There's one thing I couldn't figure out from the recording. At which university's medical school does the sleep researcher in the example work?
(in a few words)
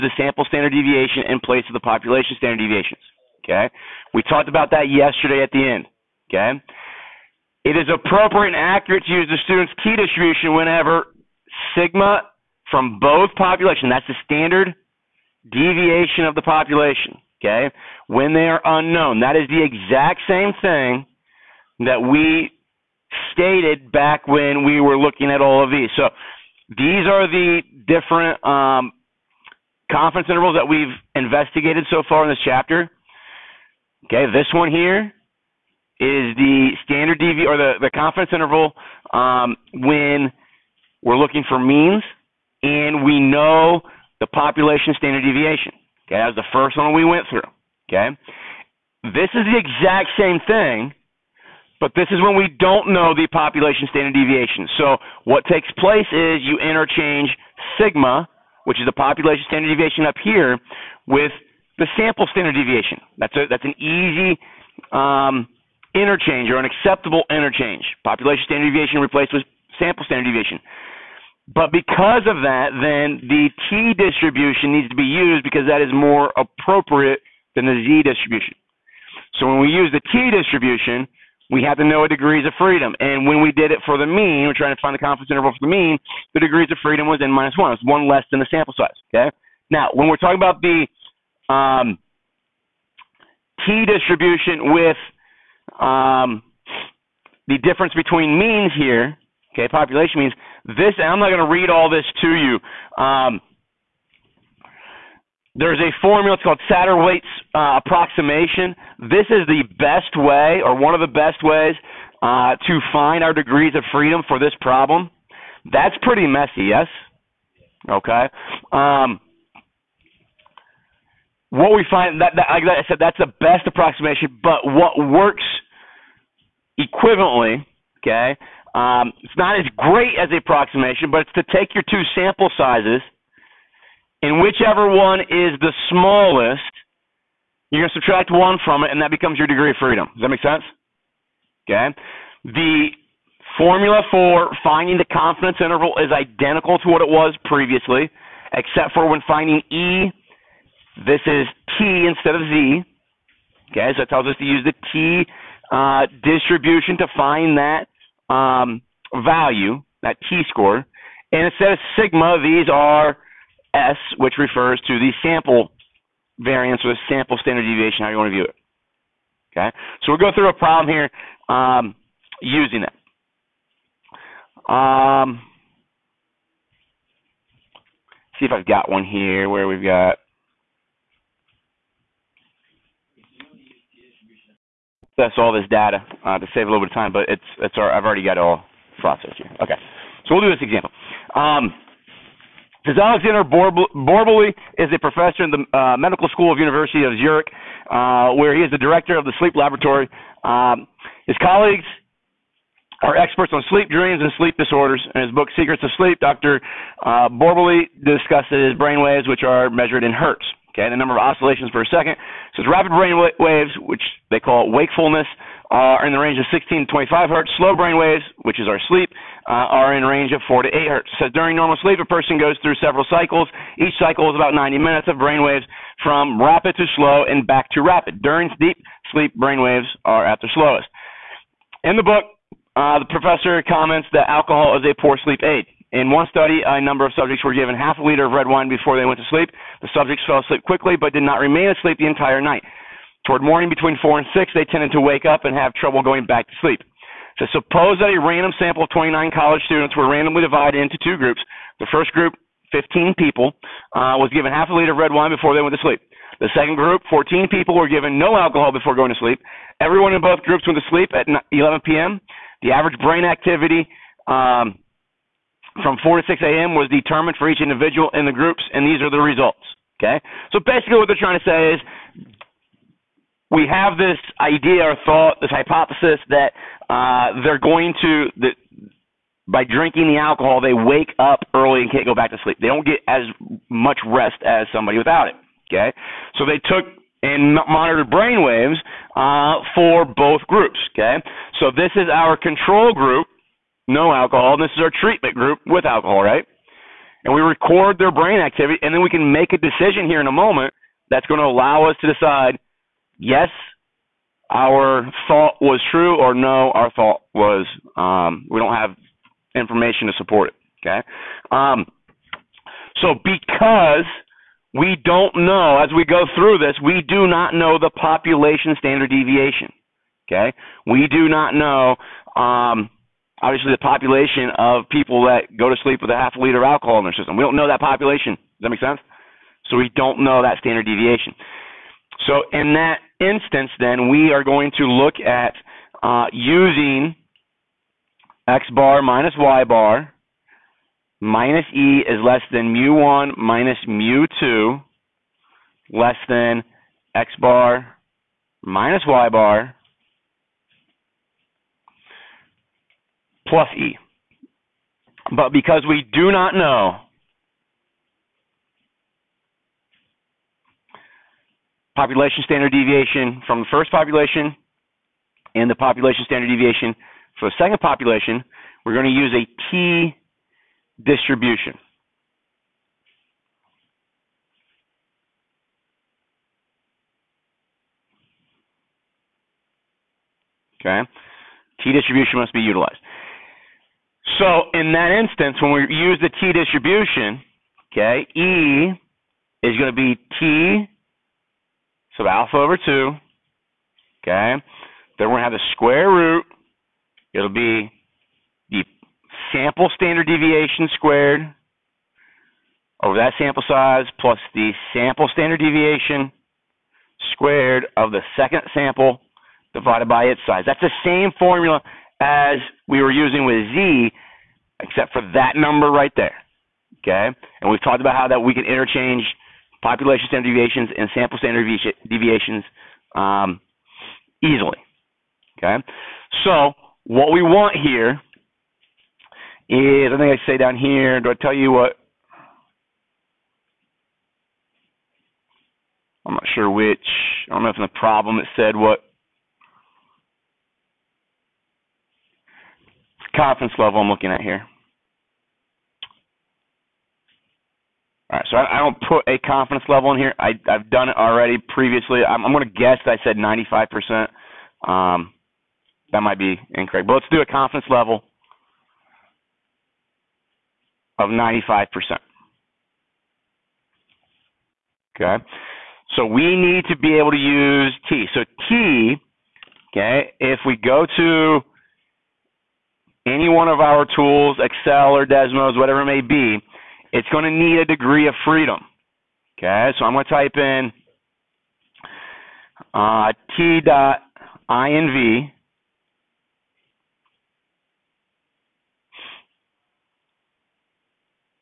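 University of Zurich.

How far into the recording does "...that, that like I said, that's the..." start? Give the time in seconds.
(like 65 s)
122 s.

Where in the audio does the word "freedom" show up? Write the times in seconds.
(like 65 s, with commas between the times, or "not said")
82 s, 86 s, 113 s, 139 s, 478 s.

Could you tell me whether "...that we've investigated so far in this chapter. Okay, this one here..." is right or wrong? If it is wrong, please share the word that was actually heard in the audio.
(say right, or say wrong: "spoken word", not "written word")
right.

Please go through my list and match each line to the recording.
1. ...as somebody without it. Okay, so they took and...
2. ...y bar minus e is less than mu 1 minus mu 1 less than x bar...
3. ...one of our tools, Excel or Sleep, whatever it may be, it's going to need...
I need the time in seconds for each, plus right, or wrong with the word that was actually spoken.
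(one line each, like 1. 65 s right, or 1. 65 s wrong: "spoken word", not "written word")
1. 284 s right
2. 339 s wrong: "2", not "1"
3. 473 s wrong: "Desmos", not "Sleep".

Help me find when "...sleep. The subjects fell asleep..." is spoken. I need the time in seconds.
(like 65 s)
239 s.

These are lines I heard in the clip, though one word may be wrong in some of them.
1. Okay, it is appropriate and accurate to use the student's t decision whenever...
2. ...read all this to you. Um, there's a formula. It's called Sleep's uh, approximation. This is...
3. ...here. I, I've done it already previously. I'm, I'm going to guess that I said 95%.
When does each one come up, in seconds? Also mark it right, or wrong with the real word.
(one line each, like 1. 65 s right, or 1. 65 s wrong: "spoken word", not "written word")
1. 6 s wrong: "distribution", not "decision"
2. 101 s wrong: "Satterthwaite", not "Sleep"
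3. 450 s right.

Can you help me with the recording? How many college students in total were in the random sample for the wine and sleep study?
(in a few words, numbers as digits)
29.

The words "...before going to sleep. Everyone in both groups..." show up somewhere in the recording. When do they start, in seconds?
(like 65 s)
258 s.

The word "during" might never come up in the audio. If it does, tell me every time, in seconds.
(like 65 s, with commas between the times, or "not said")
221 s, 228 s.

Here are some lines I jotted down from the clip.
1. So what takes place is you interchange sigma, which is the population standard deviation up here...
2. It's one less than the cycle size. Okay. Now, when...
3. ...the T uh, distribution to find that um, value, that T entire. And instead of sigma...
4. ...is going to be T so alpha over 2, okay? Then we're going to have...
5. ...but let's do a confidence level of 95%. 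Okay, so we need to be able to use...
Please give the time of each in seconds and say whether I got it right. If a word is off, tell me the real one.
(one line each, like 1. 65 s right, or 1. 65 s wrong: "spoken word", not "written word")
1. 54 s right
2. 87 s wrong: "sample", not "cycle"
3. 154 s wrong: "score", not "entire"
4. 389 s right
5. 457 s right.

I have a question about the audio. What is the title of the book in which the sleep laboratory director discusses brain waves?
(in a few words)
Secrets of Sleep.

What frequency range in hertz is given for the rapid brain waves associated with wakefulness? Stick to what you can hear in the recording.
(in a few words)
16 to 25 hertz.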